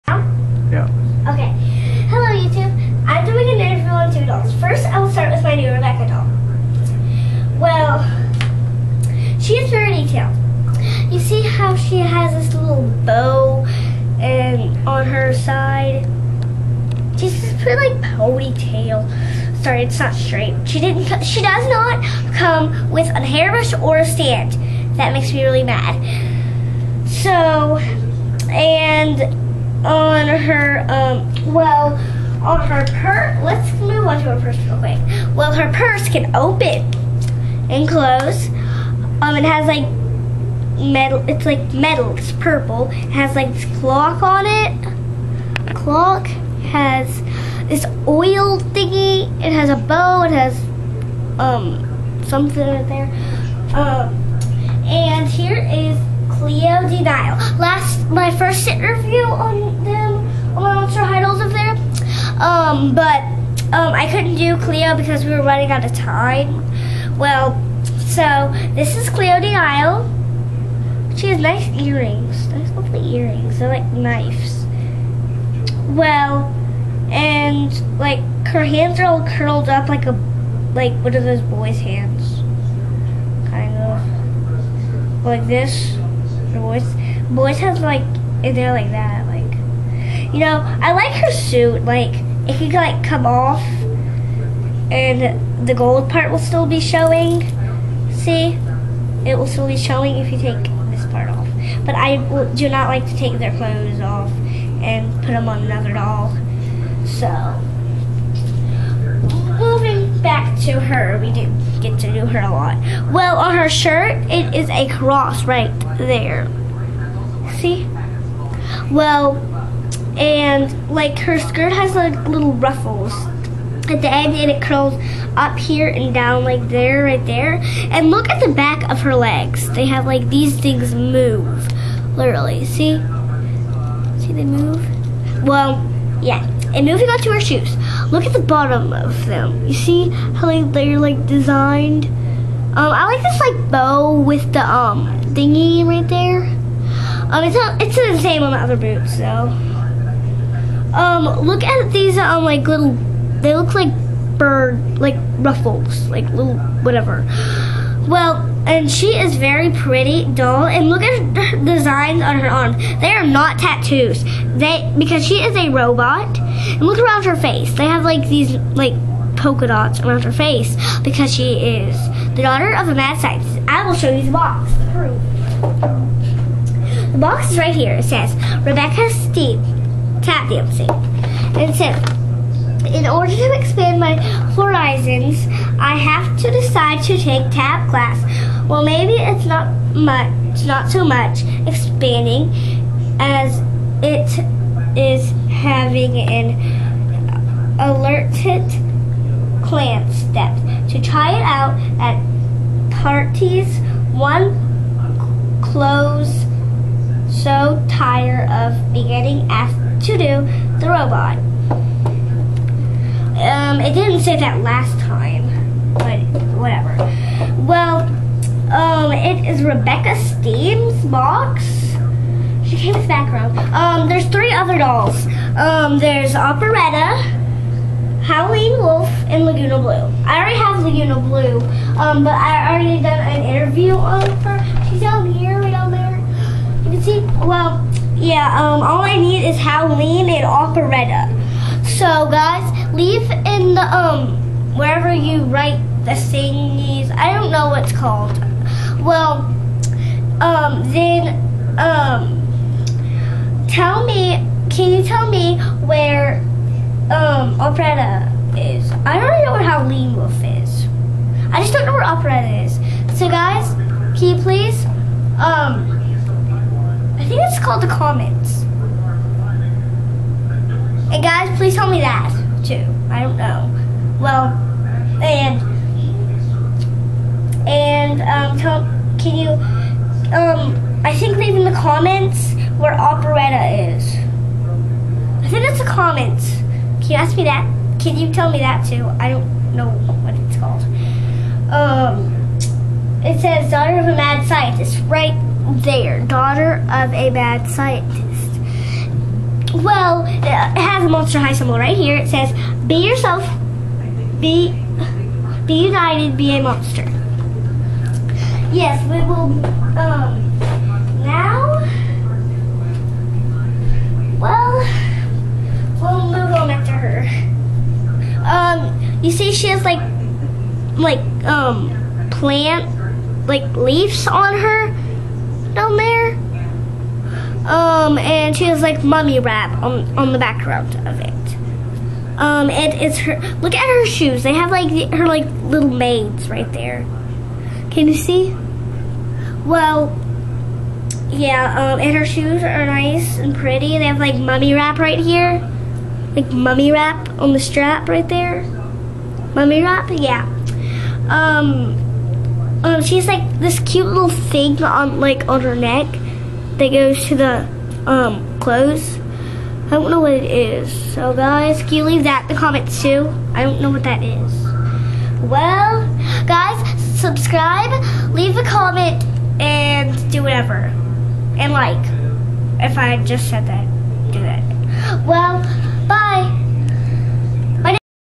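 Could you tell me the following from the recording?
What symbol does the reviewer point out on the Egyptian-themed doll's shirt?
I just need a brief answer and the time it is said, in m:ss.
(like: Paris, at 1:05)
A cross, at 1:54.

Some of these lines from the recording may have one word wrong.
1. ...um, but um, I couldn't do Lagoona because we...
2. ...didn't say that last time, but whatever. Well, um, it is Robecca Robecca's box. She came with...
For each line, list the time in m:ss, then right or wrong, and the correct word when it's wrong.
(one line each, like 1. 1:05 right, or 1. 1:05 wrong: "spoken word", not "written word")
1. 1:02 wrong: "Cleo", not "Lagoona"
2. 3:33 wrong: "Steam", not "Robecca".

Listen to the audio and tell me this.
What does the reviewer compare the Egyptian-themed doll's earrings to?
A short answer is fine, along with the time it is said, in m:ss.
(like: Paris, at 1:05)
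Knives, at 1:13.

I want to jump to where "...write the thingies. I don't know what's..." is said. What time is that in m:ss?
4:05.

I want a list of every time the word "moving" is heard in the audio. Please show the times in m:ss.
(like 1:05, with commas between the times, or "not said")
1:49, 2:16.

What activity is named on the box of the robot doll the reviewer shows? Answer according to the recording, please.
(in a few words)
Tap dancing.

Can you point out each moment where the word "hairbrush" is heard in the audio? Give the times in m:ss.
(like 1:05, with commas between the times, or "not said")
0:23.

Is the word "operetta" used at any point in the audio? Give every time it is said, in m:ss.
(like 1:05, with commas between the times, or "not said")
3:46, 4:00, 4:17, 4:22, 4:42.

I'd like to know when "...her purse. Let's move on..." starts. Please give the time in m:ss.
0:32.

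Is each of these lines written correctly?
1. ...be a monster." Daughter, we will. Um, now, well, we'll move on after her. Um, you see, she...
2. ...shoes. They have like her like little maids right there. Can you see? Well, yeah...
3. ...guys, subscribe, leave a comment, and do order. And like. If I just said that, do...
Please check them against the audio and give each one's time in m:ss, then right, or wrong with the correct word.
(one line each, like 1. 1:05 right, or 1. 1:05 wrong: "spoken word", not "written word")
1. 5:06 wrong: "Yes", not "Daughter"
2. 5:34 right
3. 6:06 wrong: "whatever", not "order".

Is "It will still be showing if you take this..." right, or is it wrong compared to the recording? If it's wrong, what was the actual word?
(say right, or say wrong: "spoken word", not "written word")
right.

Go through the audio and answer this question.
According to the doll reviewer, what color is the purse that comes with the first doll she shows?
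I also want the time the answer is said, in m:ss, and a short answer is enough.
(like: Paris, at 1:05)
Purple, at 0:42.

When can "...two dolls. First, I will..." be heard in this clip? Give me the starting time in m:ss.
0:04.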